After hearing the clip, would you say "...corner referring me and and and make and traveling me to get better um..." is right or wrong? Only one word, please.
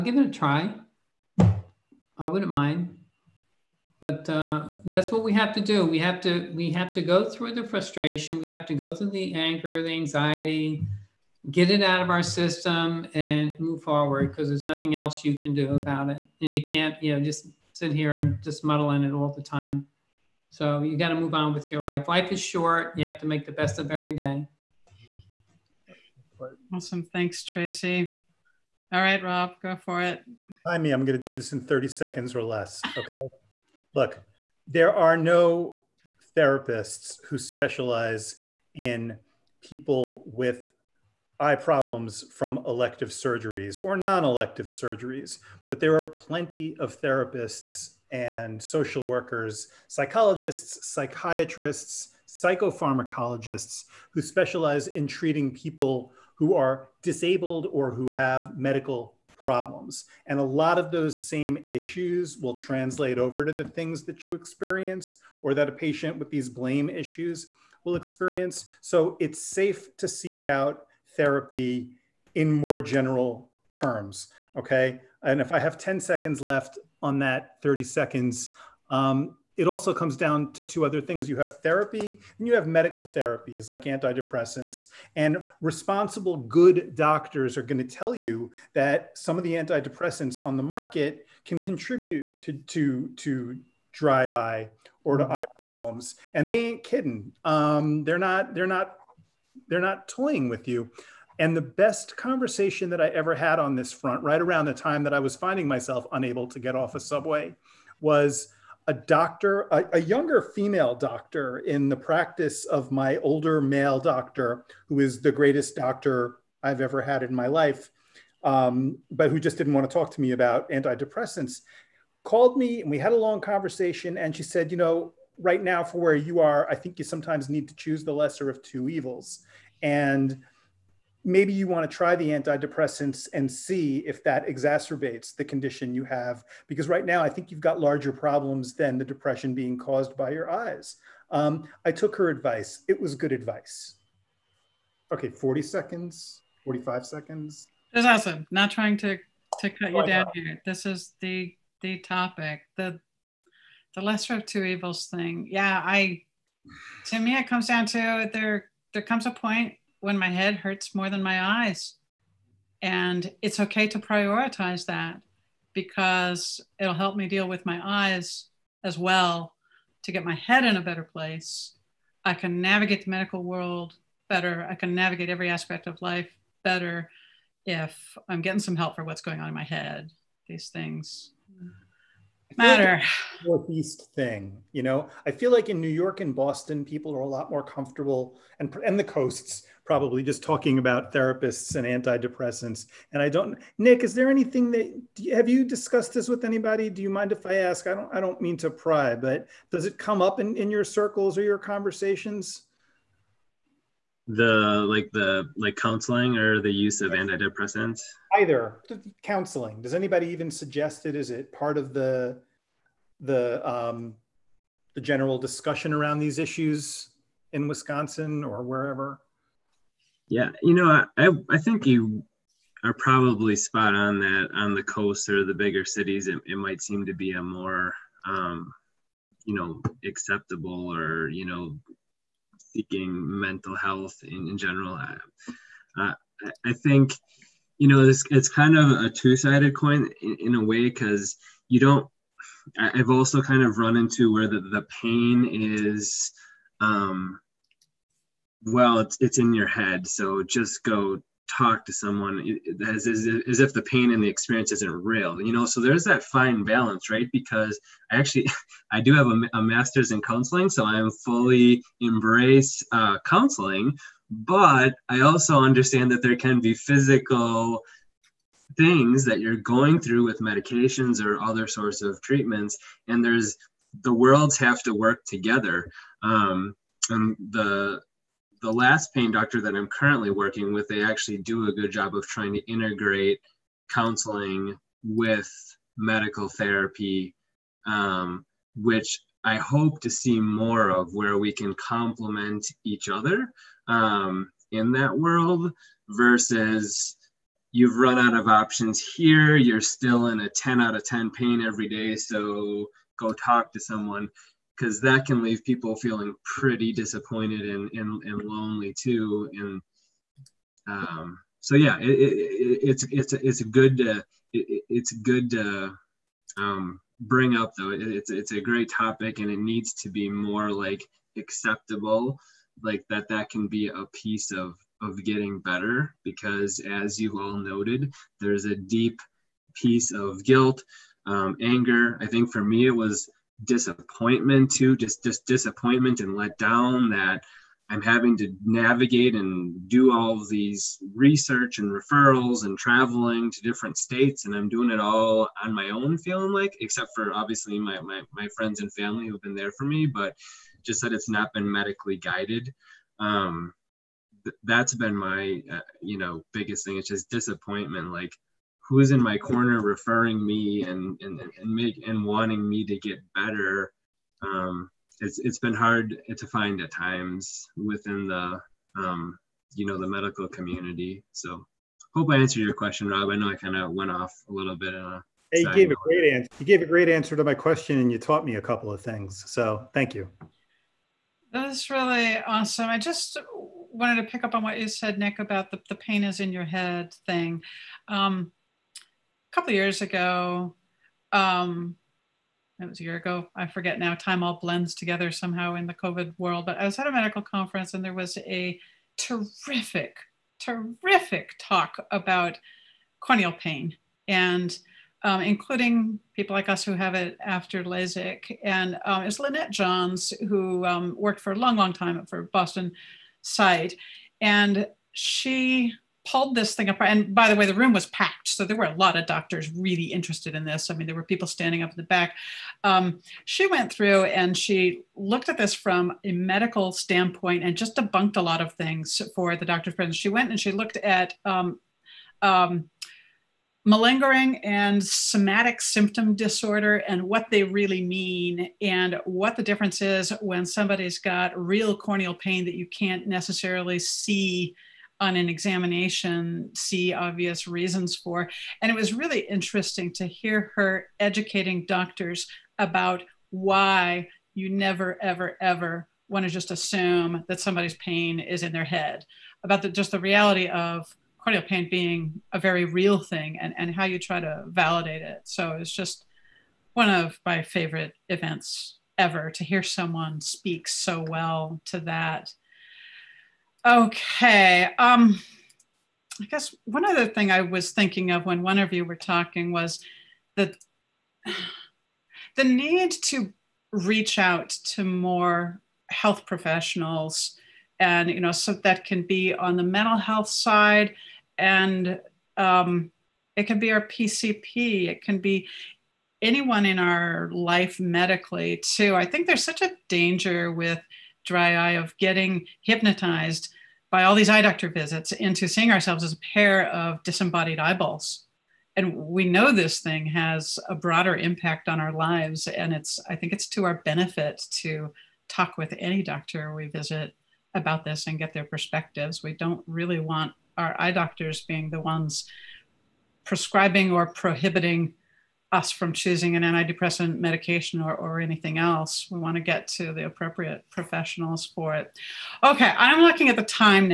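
wrong.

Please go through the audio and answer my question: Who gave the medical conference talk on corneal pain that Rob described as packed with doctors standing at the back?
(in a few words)
Lynette Johns.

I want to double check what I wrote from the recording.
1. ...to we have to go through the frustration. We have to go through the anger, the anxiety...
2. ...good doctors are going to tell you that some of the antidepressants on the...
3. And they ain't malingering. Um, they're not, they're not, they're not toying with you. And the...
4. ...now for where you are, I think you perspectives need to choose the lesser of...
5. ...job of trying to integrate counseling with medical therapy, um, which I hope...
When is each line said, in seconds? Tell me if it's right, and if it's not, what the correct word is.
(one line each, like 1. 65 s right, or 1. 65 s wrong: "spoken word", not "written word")
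1. 6 s right
2. 86 s right
3. 96 s wrong: "kidding", not "malingering"
4. 125 s wrong: "sometimes", not "perspectives"
5. 281 s right.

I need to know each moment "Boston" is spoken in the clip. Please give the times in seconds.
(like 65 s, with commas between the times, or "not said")
186 s, 412 s.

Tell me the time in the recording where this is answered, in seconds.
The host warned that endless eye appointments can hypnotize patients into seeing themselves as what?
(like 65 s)
506 s.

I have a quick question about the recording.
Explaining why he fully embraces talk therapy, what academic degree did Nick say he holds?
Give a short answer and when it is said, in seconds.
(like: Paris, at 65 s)
Master's in counseling, at 259 s.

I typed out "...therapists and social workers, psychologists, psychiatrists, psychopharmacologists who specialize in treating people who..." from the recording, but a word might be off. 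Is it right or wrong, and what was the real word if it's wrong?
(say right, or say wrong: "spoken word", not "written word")
right.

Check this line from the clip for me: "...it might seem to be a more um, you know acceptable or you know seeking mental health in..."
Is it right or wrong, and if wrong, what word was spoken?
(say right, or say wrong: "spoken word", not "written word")
right.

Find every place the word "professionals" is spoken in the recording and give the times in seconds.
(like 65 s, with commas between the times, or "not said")
486 s, 530 s.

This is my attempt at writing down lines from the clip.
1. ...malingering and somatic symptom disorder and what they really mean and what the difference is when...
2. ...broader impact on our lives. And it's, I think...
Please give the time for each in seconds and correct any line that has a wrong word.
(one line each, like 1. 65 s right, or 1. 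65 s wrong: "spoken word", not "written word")
1. 433 s right
2. 510 s right.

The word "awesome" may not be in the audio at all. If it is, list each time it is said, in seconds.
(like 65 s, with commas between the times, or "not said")
26 s, 148 s, 382 s.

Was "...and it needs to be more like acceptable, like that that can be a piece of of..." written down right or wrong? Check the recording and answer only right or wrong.
right.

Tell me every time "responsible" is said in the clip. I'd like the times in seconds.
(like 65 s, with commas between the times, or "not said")
85 s.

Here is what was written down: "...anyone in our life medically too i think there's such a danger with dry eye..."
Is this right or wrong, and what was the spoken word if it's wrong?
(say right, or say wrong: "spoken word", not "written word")
right.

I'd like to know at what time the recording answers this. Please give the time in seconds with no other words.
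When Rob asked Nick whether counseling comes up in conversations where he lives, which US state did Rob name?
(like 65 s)
217 s.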